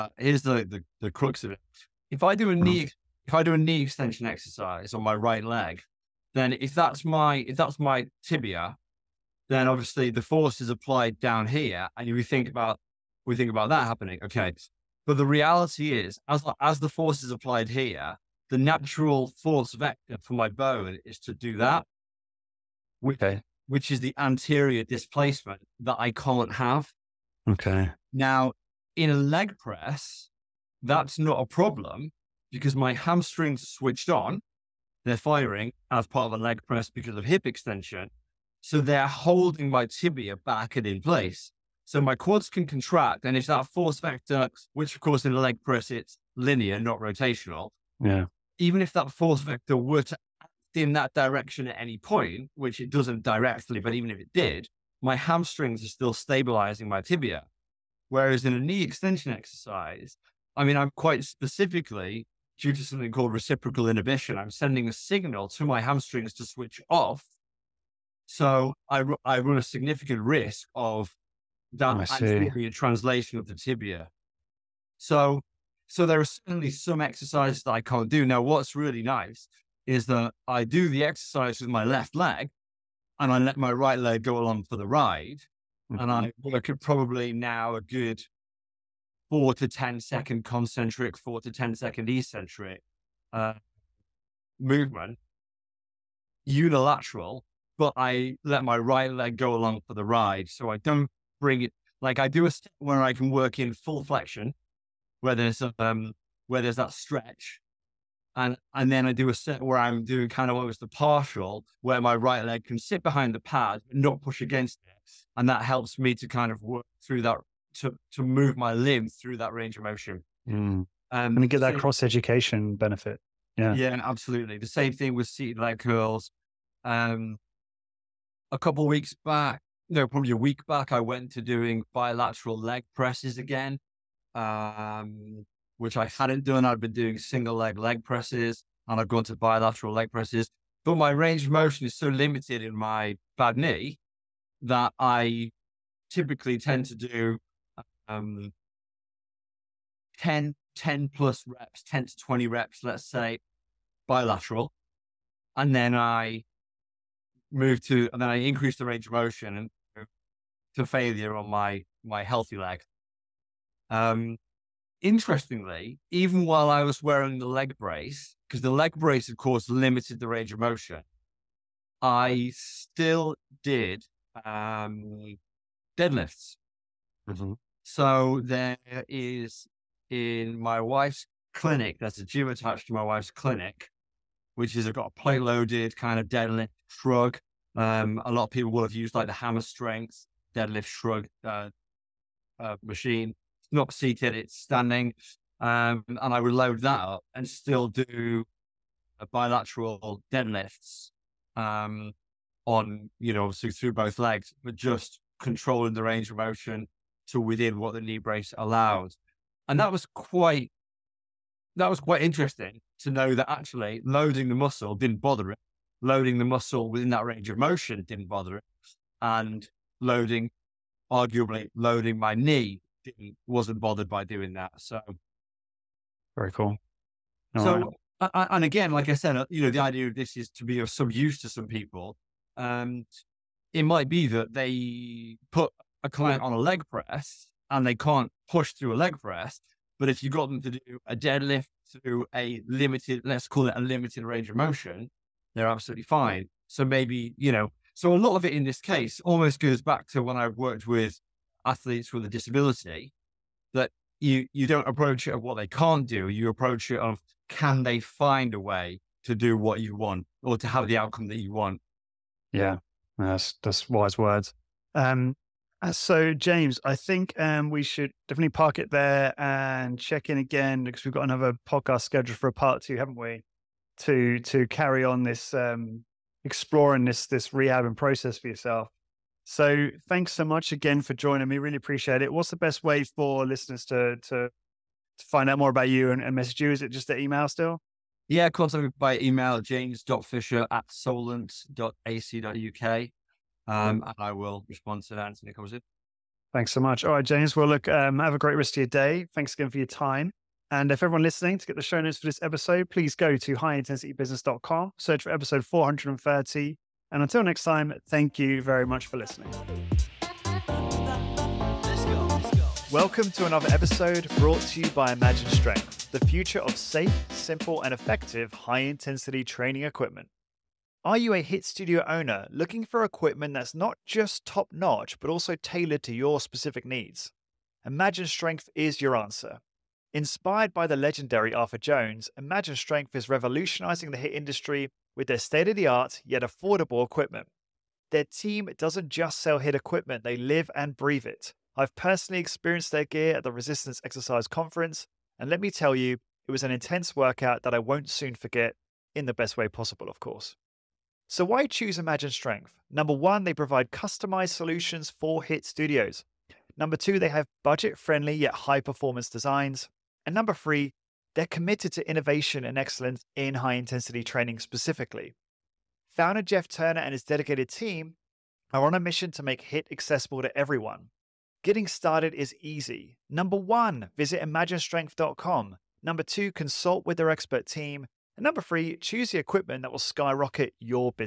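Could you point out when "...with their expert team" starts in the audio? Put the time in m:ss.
6:17.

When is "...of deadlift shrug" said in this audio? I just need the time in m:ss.
3:06.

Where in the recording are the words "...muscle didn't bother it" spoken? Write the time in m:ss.
3:34.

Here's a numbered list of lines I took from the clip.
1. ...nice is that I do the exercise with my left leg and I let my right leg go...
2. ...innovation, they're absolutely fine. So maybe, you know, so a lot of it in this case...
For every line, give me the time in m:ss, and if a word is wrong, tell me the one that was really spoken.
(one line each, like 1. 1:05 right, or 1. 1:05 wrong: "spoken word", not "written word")
1. 1:19 right
2. 4:04 wrong: "motion", not "innovation".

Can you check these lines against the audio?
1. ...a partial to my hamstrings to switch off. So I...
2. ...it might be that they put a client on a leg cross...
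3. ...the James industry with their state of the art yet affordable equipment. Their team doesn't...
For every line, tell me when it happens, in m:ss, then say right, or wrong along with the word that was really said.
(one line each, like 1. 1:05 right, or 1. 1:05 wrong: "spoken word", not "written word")
1. 1:04 wrong: "signal", not "partial"
2. 3:53 wrong: "press", not "cross"
3. 5:34 wrong: "HIT", not "James".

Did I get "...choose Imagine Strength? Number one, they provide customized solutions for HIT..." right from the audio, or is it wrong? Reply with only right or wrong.
right.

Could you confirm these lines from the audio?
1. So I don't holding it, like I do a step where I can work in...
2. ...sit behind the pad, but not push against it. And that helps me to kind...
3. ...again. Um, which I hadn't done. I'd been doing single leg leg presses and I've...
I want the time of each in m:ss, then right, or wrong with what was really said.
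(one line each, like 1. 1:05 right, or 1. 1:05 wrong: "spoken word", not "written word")
1. 1:40 wrong: "bring", not "holding"
2. 1:52 right
3. 2:13 right.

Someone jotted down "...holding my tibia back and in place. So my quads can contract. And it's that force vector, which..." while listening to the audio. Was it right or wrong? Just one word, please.
right.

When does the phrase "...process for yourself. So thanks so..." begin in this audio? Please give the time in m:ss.
4:37.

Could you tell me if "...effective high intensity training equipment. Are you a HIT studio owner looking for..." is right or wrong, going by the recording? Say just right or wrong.
right.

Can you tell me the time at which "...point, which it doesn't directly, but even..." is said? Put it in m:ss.
0:51.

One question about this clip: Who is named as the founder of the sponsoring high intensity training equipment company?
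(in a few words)
Jeff Turner.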